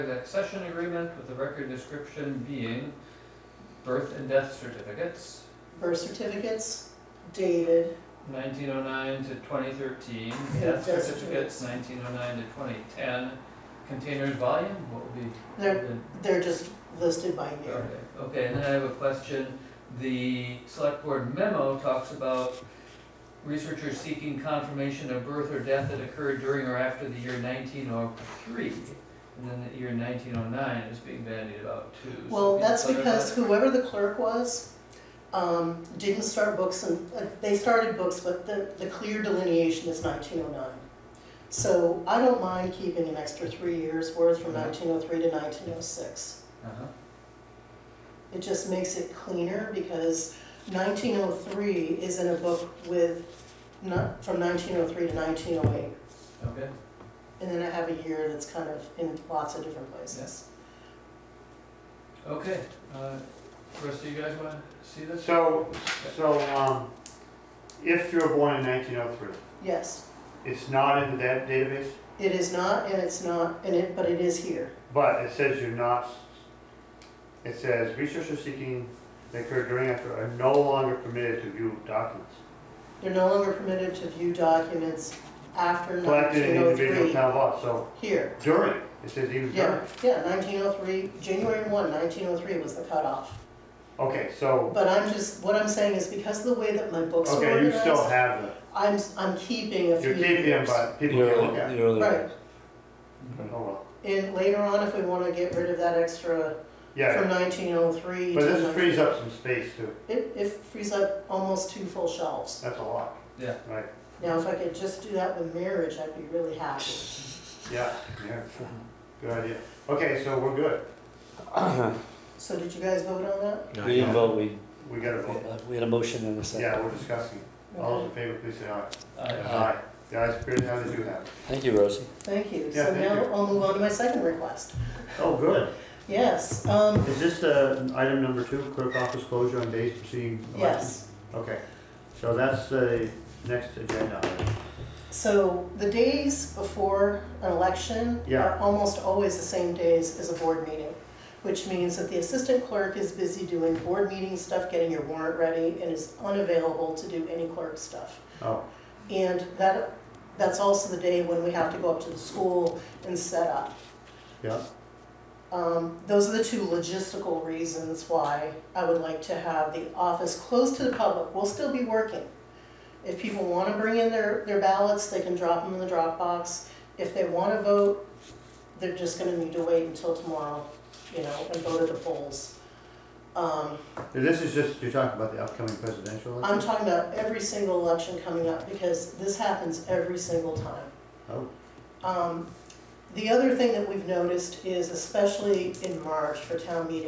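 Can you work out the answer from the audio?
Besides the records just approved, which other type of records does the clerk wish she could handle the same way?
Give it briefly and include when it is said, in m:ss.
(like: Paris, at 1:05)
marriage, at 1:55.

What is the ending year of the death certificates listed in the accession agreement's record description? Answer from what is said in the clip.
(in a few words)
2010.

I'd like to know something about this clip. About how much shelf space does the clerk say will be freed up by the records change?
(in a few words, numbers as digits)
almost two full shelves.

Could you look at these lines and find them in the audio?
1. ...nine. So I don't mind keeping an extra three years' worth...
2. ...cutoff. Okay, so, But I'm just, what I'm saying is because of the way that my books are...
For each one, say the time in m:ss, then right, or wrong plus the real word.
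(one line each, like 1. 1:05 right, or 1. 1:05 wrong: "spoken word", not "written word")
1. 0:40 right
2. 1:32 right.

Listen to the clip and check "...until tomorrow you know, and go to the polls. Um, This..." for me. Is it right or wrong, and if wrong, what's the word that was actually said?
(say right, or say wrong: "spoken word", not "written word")
right.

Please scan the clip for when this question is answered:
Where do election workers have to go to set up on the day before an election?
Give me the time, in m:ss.
2:42.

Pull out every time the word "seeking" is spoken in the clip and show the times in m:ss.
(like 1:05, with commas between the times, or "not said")
0:23, 1:18.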